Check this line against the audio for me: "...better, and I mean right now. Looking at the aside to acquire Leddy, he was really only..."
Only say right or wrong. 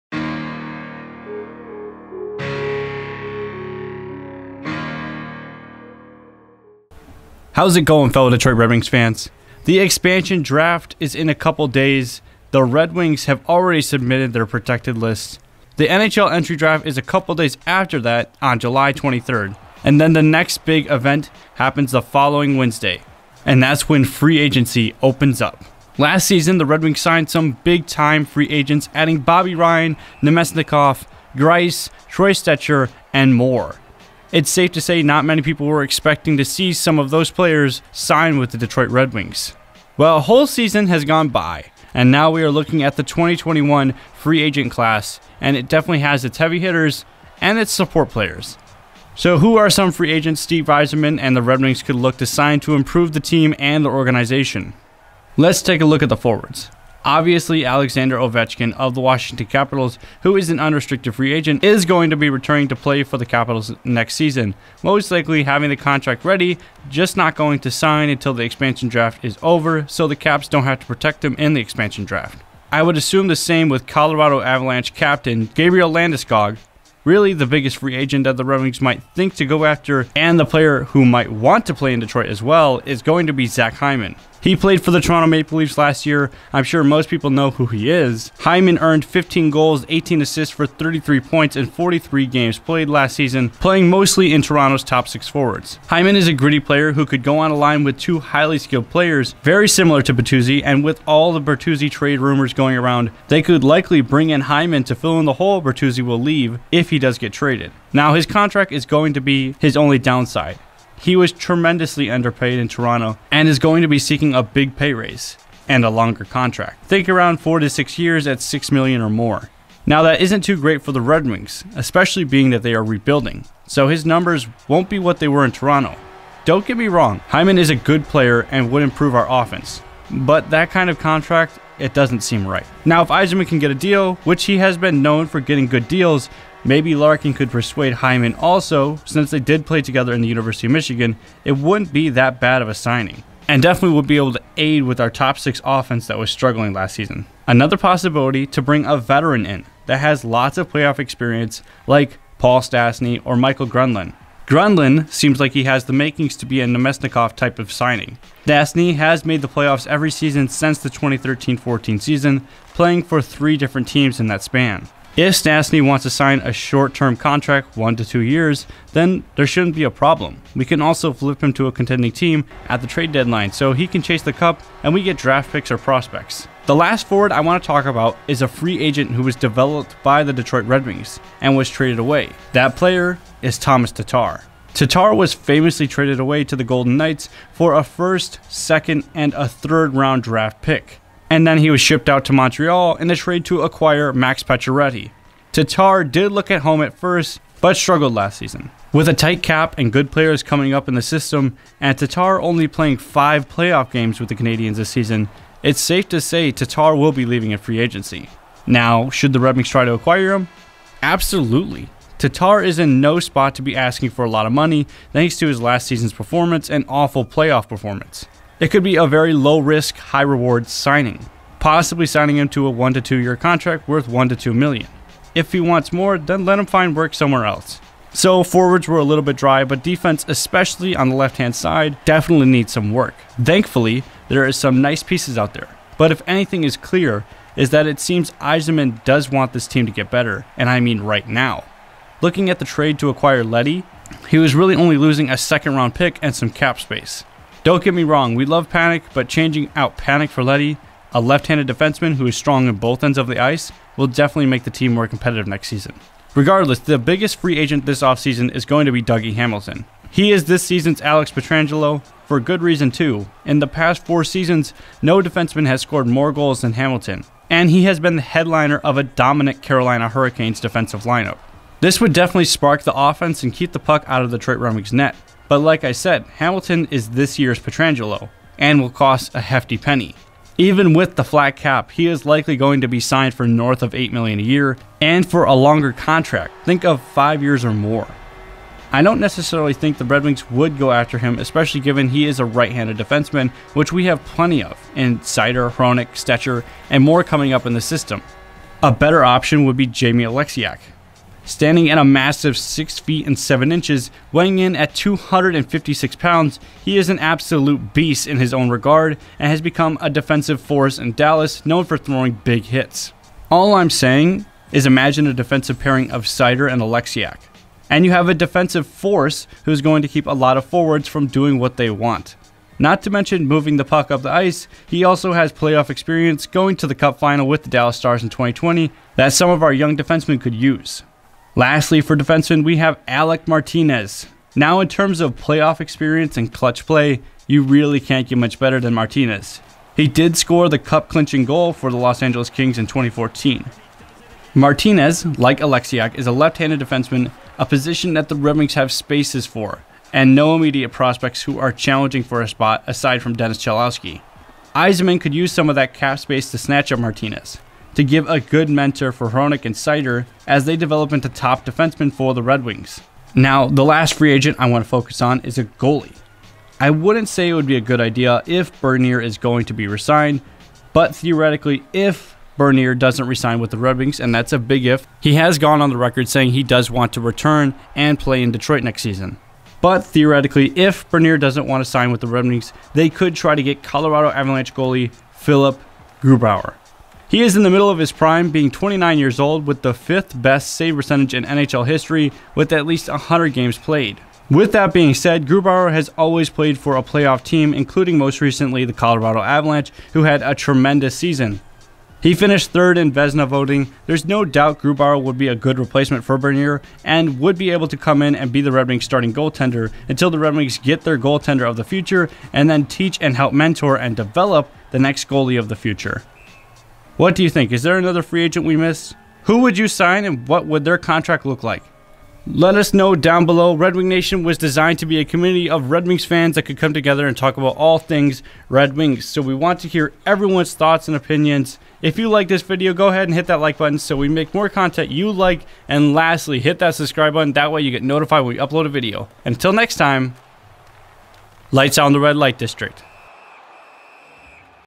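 wrong.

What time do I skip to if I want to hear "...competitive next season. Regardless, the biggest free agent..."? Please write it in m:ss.
4:15.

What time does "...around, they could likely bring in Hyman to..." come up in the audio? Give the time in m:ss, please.
1:42.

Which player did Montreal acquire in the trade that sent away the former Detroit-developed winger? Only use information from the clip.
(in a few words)
Max Pacioretty.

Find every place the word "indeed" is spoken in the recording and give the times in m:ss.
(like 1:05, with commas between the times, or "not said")
not said.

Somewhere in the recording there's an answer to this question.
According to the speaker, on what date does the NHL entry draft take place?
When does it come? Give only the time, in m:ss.
0:18.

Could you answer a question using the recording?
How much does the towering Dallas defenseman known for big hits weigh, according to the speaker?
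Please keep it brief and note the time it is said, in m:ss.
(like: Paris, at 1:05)
256 pounds, at 5:04.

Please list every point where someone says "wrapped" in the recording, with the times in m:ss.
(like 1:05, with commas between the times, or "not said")
not said.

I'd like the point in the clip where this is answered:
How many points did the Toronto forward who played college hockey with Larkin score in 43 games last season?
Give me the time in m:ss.
1:30.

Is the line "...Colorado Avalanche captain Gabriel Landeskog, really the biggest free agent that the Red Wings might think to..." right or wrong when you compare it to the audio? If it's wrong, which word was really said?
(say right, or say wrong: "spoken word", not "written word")
right.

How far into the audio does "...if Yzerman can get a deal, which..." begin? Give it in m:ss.
2:13.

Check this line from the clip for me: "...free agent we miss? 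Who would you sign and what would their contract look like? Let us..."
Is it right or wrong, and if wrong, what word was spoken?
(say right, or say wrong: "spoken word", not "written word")
right.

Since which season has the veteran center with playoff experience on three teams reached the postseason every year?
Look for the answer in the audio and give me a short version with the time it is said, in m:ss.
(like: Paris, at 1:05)
2013-14, at 2:40.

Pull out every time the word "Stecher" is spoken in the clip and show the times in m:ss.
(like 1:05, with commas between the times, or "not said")
0:32, 4:56.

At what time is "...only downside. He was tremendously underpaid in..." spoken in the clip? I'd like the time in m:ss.
1:49.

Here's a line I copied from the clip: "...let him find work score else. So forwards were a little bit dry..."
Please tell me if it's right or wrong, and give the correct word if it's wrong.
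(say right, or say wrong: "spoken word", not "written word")
wrong: "somewhere", not "score".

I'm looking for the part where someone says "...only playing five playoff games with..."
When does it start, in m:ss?
3:22.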